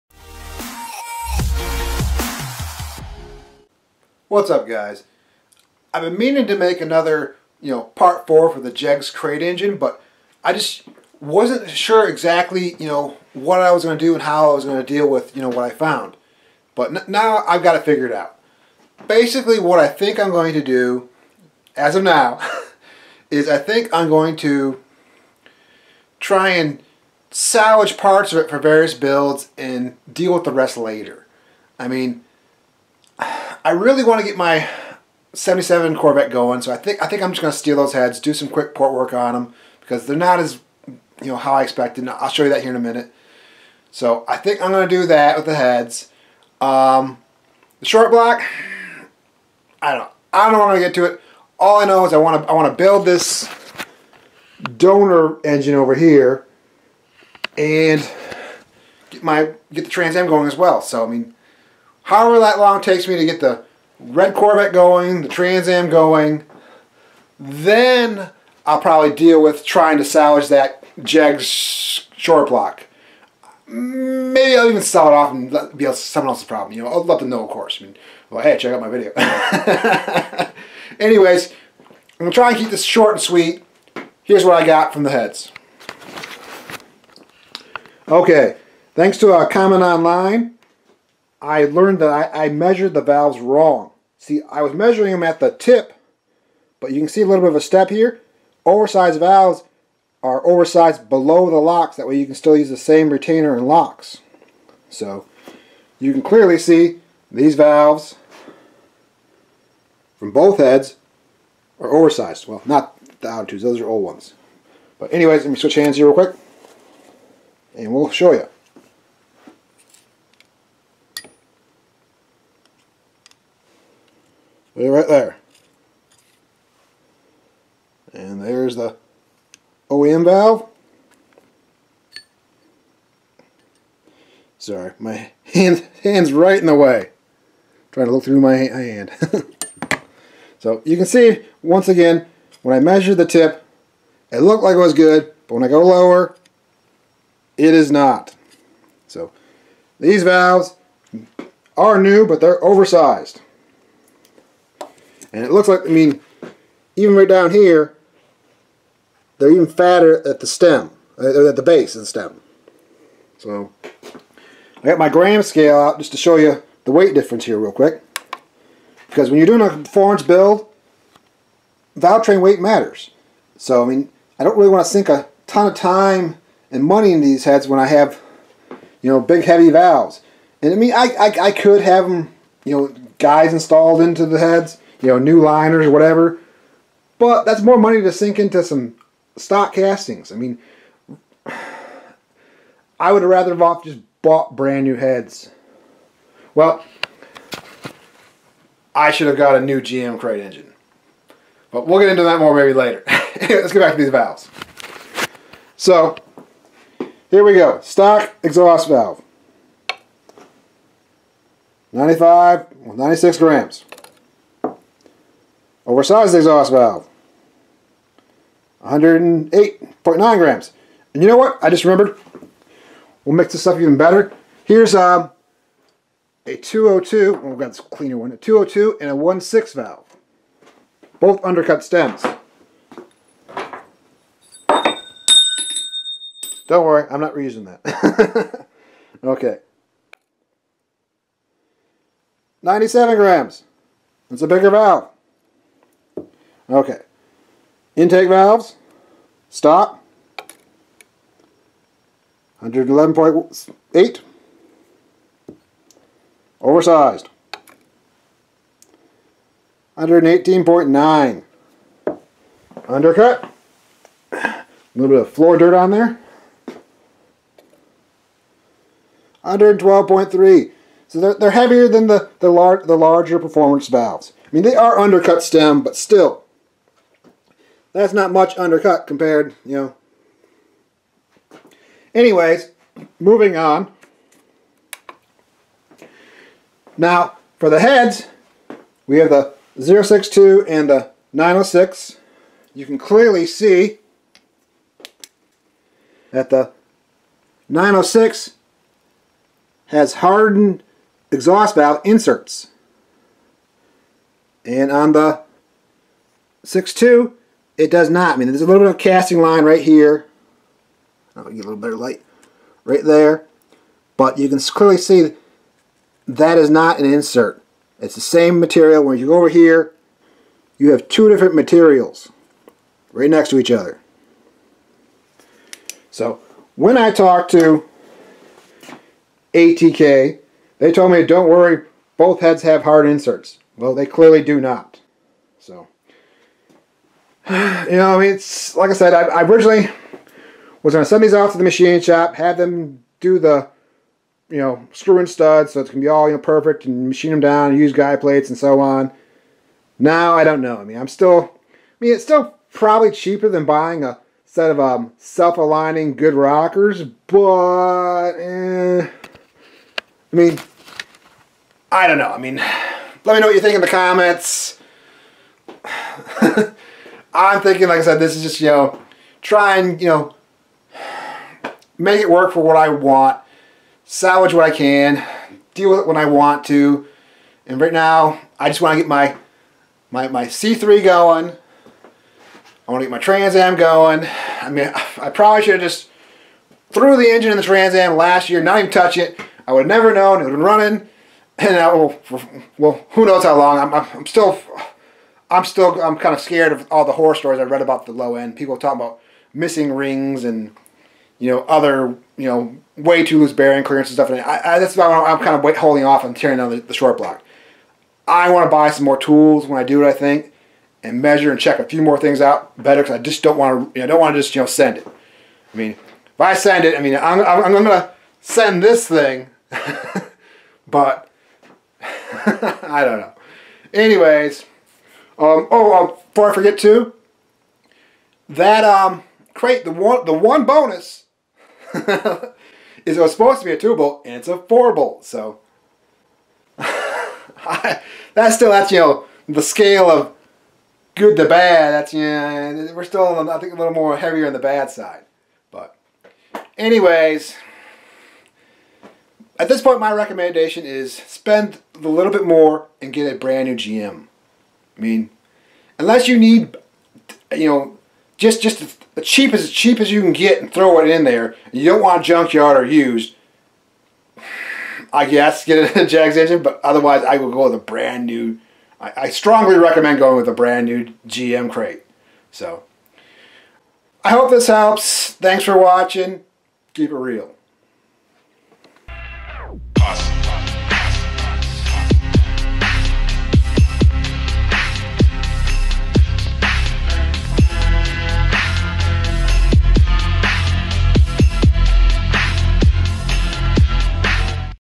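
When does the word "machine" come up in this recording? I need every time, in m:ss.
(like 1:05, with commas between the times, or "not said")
5:41, 5:47.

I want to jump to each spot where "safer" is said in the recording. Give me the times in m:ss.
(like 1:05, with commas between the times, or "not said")
not said.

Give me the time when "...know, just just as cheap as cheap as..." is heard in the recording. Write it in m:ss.
7:37.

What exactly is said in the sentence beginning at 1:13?
Maybe I'll even sell it off and let, be someone else's problem.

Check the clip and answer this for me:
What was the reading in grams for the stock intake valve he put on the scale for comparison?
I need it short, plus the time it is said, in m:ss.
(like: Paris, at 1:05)
111.8, at 4:12.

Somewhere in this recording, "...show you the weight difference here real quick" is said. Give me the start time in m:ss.
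2:46.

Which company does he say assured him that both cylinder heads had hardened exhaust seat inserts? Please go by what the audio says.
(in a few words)
ATK.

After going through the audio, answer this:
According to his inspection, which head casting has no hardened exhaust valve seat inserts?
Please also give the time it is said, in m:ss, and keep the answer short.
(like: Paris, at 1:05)
062, at 4:49.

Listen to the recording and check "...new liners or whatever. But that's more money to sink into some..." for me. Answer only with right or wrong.
right.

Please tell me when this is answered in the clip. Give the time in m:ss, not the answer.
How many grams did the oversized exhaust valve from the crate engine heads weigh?
3:38.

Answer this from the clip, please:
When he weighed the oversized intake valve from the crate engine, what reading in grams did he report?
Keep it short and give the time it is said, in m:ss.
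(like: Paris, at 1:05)
118.9, at 4:19.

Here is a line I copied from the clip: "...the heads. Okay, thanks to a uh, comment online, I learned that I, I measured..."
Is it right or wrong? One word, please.
right.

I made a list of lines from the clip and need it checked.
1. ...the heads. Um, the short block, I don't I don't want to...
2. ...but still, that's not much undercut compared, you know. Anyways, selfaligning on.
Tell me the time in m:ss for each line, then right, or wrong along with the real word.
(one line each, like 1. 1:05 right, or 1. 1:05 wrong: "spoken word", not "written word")
1. 0:45 right
2. 4:35 wrong: "moving", not "selfaligning".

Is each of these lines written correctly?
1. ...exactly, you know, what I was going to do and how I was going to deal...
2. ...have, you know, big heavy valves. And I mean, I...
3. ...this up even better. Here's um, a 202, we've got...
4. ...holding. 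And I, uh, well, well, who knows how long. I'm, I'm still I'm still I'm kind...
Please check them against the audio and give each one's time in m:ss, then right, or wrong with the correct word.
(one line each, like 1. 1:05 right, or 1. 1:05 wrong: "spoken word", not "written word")
1. 0:12 right
2. 2:57 right
3. 3:43 right
4. 6:30 wrong: "running", not "holding".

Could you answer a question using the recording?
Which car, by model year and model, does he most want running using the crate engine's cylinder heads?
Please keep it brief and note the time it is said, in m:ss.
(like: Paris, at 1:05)
77 Corvette, at 0:35.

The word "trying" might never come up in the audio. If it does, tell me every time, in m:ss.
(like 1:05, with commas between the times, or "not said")
1:09, 2:17.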